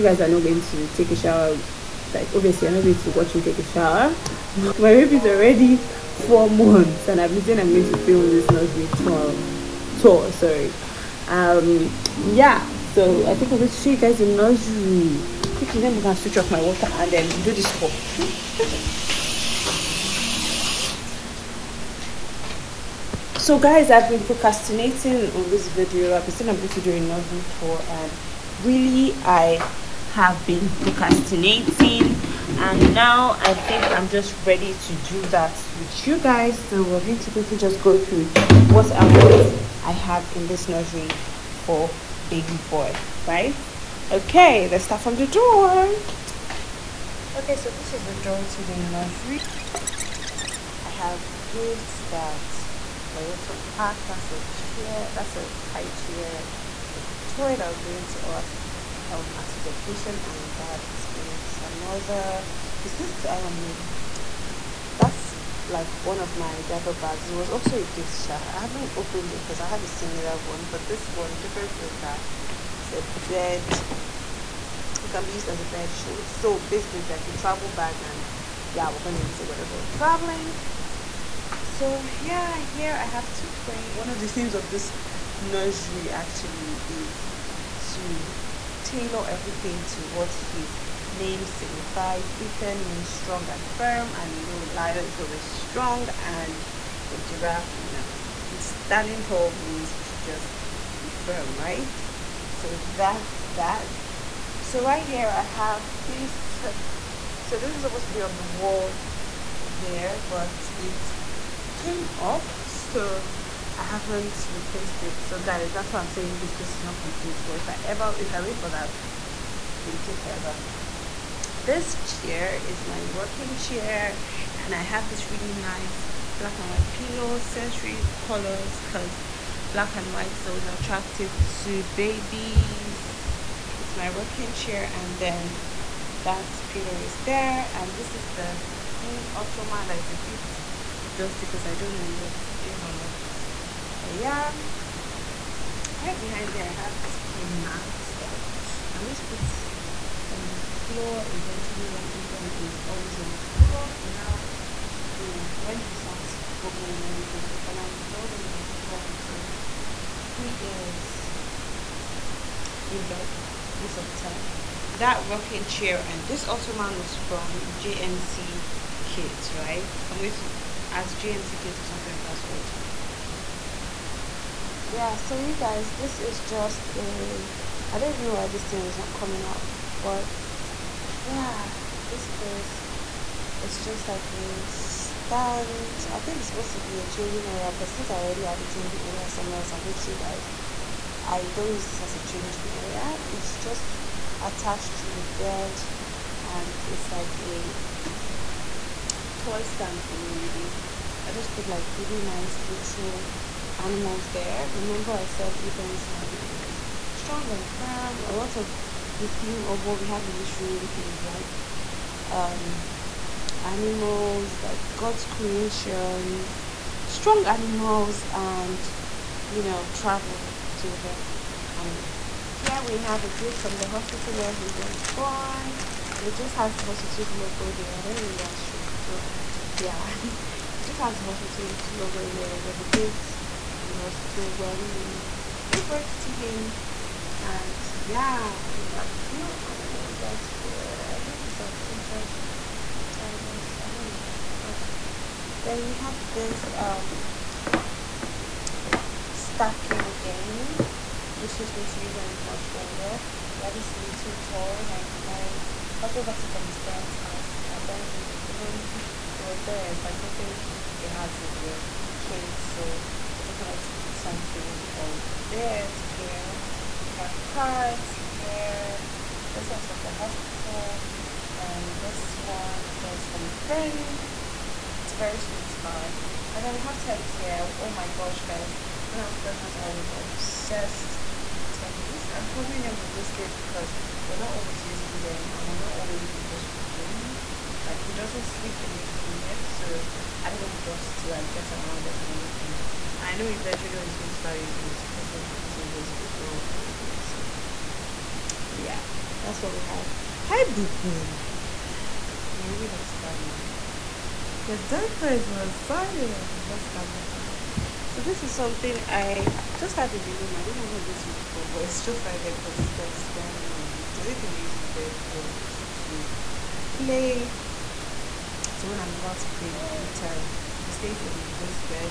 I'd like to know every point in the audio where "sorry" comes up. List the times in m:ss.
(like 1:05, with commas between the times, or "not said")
0:10.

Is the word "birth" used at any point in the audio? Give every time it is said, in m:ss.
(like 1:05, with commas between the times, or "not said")
3:55.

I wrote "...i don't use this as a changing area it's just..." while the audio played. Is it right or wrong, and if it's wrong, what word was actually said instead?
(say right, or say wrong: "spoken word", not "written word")
right.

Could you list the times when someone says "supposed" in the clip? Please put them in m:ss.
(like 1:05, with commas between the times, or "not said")
1:47, 3:06.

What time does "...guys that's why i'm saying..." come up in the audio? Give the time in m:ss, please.
1:55.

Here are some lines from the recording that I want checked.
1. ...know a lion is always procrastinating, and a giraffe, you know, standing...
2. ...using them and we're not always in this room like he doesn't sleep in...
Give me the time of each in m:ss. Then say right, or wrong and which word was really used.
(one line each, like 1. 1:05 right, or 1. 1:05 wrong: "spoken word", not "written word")
1. 1:34 wrong: "strong", not "procrastinating"
2. 4:44 right.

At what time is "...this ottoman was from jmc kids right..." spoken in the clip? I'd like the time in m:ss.
2:46.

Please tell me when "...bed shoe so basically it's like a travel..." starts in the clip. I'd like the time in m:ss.
1:15.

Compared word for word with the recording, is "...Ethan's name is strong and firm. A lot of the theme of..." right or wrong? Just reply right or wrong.
right.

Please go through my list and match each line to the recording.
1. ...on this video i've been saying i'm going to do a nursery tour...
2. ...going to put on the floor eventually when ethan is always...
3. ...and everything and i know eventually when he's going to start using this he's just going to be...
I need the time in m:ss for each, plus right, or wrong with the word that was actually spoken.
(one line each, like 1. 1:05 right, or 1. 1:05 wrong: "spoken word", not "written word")
1. 0:25 right
2. 2:29 right
3. 4:52 right.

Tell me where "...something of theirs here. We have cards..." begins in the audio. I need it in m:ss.
4:24.